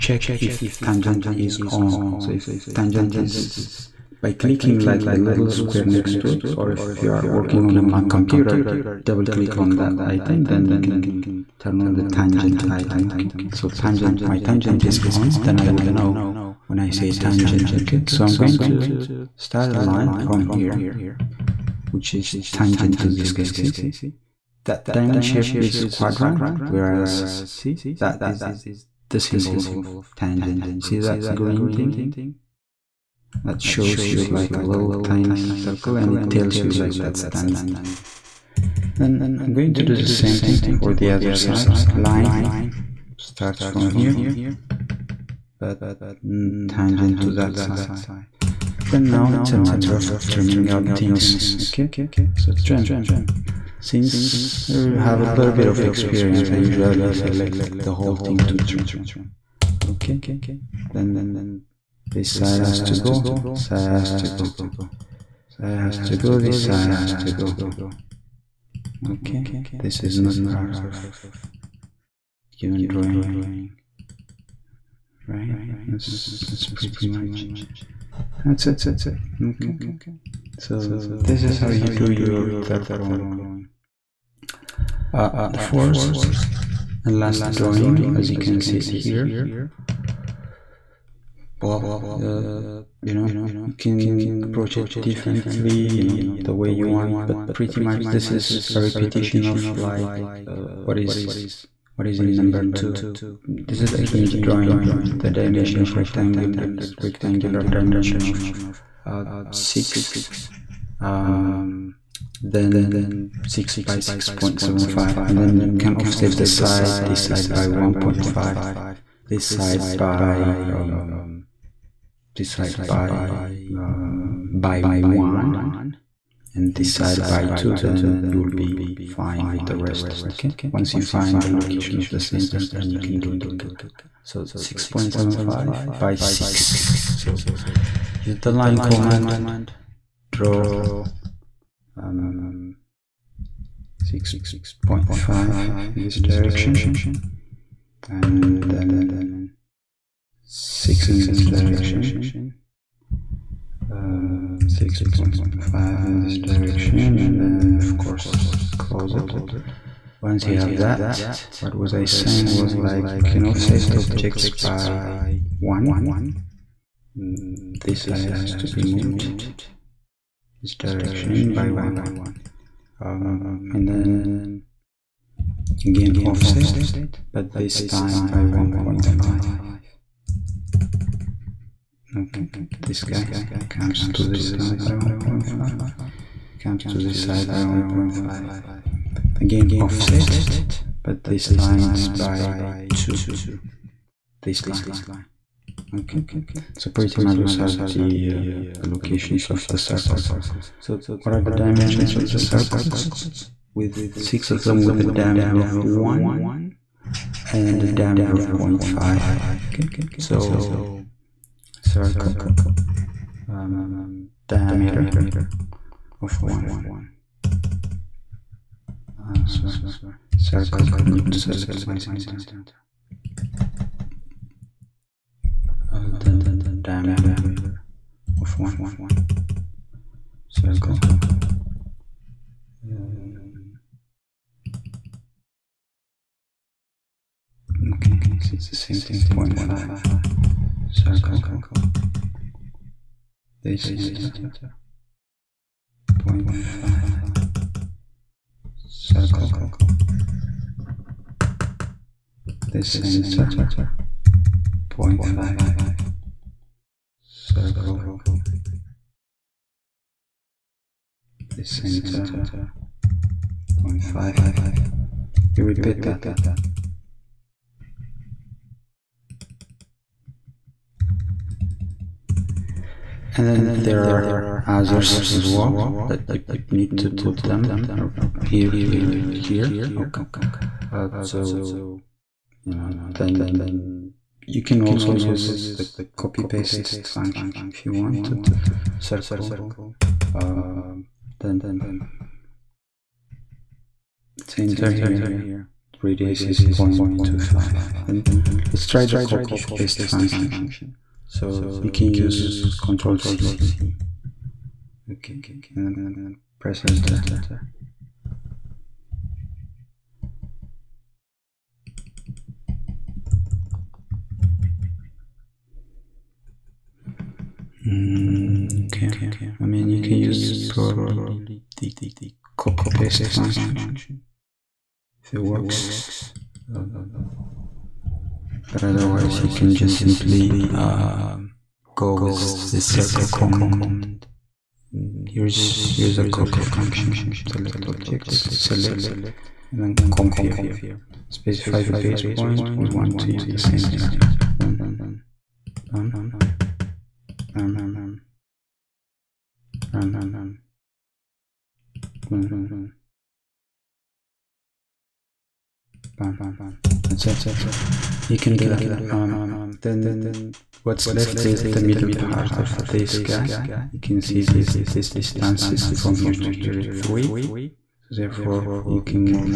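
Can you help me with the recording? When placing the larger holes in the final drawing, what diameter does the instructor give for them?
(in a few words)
1.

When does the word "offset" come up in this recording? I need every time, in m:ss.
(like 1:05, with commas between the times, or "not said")
1:55, 2:43, 2:56, 3:09.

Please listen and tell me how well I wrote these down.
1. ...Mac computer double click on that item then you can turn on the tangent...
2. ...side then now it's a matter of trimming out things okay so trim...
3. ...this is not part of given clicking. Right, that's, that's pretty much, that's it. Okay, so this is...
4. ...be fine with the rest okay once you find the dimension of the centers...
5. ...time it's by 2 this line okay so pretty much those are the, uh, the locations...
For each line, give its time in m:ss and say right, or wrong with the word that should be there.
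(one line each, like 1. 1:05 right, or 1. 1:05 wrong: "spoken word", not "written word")
1. 0:07 right
2. 0:47 right
3. 1:09 wrong: "drawing", not "clicking"
4. 2:08 wrong: "location", not "dimension"
5. 3:11 right.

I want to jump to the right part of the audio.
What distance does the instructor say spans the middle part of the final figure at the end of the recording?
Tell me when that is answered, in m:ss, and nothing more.
6:06.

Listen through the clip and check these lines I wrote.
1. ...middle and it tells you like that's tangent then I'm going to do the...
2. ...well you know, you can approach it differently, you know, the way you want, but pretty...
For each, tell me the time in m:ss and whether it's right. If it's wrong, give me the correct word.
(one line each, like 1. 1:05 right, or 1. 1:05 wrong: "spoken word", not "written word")
1. 0:35 wrong: "circle", not "middle"
2. 1:31 right.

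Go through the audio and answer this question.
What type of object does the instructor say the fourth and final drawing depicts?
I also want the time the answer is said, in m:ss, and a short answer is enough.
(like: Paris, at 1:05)
hinge, at 1:44.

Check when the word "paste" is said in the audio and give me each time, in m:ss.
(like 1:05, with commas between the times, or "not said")
4:46, 4:59, 5:22.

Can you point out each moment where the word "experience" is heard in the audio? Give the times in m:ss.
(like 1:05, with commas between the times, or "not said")
0:55.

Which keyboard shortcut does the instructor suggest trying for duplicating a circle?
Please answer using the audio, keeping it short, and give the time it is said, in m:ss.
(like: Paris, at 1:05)
Control C, at 5:02.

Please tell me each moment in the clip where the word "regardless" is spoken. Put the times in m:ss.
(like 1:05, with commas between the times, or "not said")
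not said.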